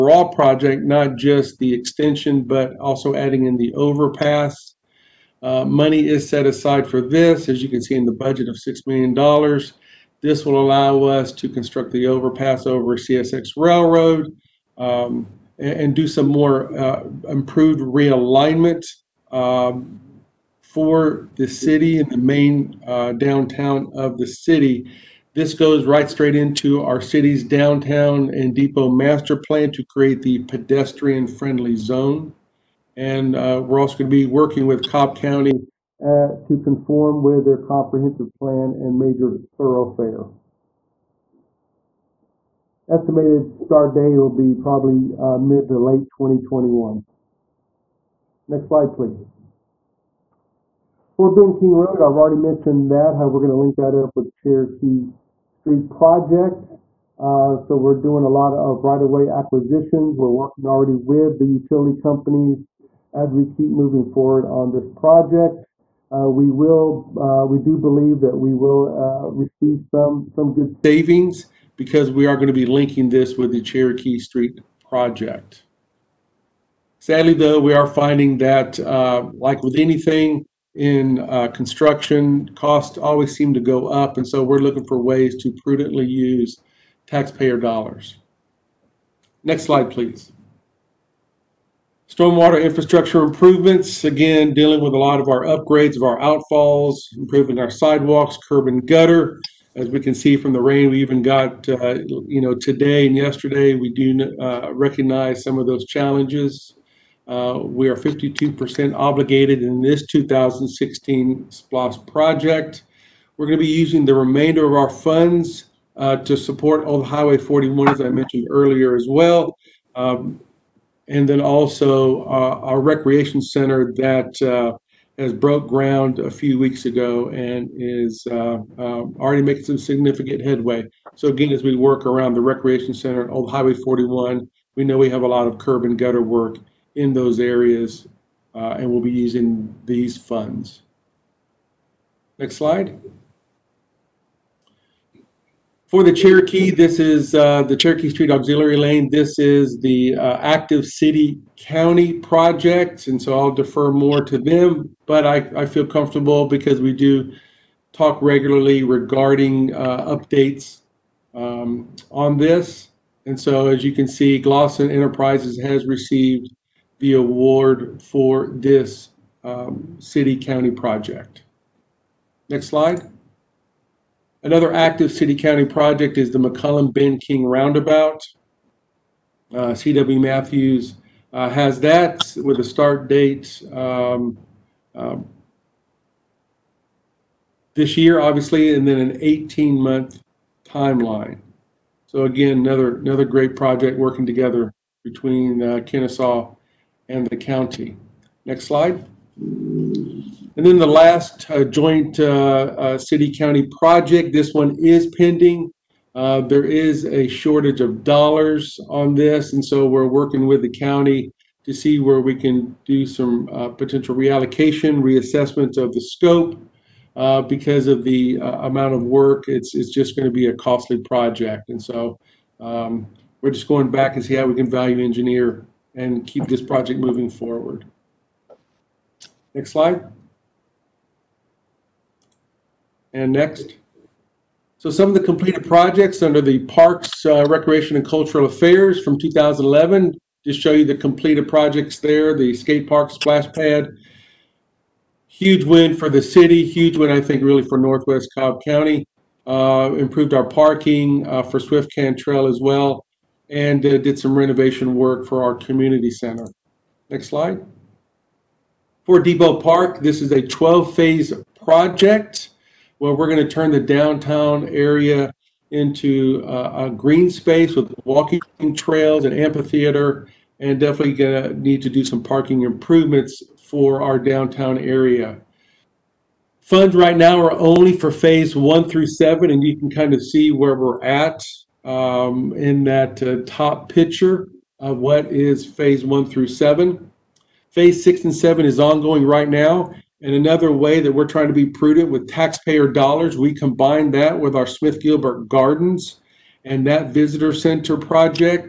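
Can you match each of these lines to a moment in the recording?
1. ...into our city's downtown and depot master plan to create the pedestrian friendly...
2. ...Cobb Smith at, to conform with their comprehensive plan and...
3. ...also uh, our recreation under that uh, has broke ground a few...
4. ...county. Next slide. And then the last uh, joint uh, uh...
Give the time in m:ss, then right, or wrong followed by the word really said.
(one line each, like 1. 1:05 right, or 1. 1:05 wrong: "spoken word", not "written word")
1. 0:26 right
2. 0:34 wrong: "County", not "Smith"
3. 2:01 wrong: "center", not "under"
4. 3:17 right.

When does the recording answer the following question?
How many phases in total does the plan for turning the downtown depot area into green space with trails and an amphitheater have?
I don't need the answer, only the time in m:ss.
4:20.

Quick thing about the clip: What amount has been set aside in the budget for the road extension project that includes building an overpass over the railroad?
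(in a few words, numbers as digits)
$6 million.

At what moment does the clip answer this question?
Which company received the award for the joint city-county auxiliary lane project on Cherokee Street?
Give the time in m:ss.
2:44.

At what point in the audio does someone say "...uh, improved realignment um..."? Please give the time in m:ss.
0:16.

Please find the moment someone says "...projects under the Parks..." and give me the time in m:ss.
3:55.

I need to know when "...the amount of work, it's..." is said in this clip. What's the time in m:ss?
3:38.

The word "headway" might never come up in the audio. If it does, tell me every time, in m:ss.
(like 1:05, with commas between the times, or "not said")
2:10.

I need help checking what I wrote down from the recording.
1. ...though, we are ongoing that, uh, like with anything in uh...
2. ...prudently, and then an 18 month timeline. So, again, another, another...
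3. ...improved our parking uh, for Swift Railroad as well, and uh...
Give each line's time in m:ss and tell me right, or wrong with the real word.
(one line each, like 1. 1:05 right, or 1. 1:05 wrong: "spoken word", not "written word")
1. 1:17 wrong: "finding", not "ongoing"
2. 3:08 wrong: "obviously", not "prudently"
3. 4:09 wrong: "Cantrell", not "Railroad".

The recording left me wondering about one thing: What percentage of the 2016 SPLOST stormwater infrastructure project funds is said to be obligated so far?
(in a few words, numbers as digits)
52%.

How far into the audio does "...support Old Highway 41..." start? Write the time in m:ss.
1:56.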